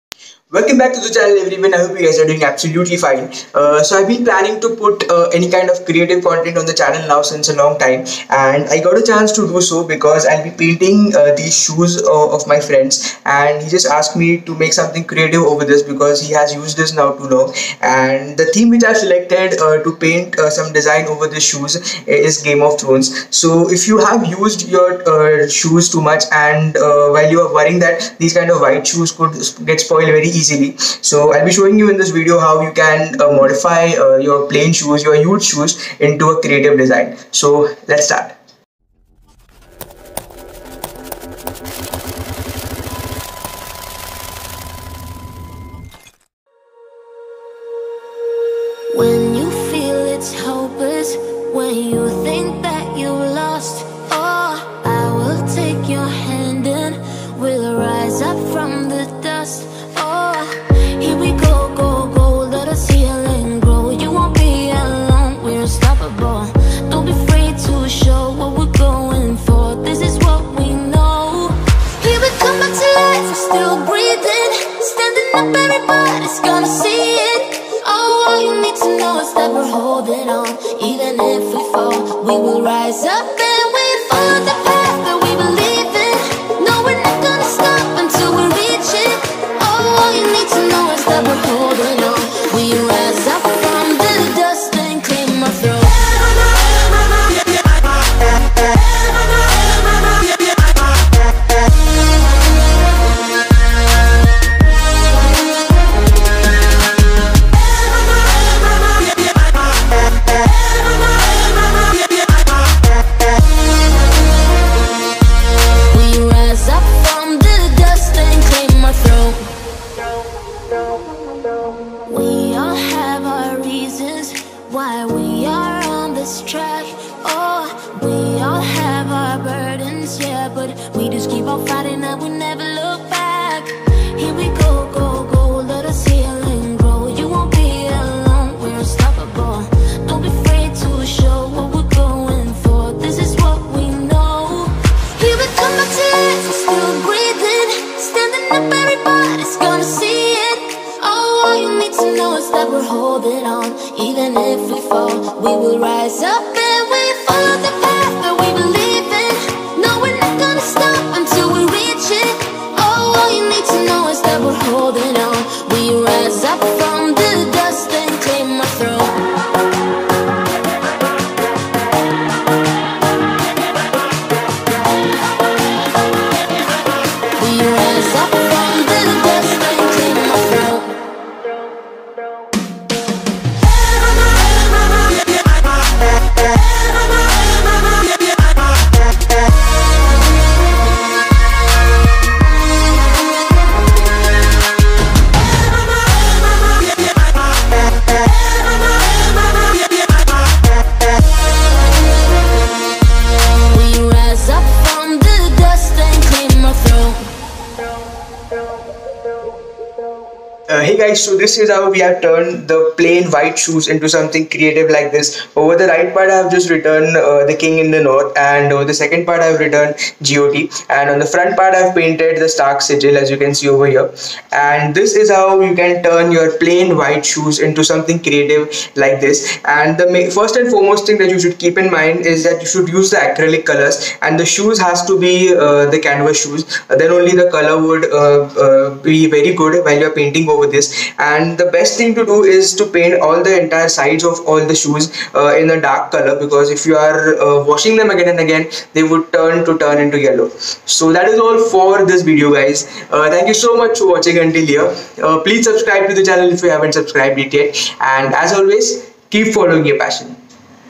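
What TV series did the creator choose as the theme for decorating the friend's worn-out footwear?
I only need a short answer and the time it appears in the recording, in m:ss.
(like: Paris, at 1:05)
Game of Thrones, at 0:22.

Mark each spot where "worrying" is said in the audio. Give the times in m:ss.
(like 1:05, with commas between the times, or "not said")
0:27.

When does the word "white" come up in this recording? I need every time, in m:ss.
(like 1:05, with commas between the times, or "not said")
0:28, 3:33, 3:46.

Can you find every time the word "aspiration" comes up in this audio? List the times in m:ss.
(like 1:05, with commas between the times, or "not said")
not said.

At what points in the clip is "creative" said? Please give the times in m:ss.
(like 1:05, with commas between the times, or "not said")
0:05, 0:15, 0:36, 3:34, 3:48.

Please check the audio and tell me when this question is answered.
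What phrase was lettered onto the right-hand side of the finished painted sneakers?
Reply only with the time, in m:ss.
3:37.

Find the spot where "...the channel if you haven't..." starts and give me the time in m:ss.
4:16.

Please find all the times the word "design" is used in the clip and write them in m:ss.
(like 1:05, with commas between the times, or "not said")
0:20, 0:36.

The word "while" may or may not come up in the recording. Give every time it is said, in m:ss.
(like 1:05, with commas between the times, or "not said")
0:26, 3:59.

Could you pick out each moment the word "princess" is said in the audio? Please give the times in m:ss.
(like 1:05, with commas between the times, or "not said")
not said.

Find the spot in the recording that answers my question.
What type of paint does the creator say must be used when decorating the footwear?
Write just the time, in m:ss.
3:53.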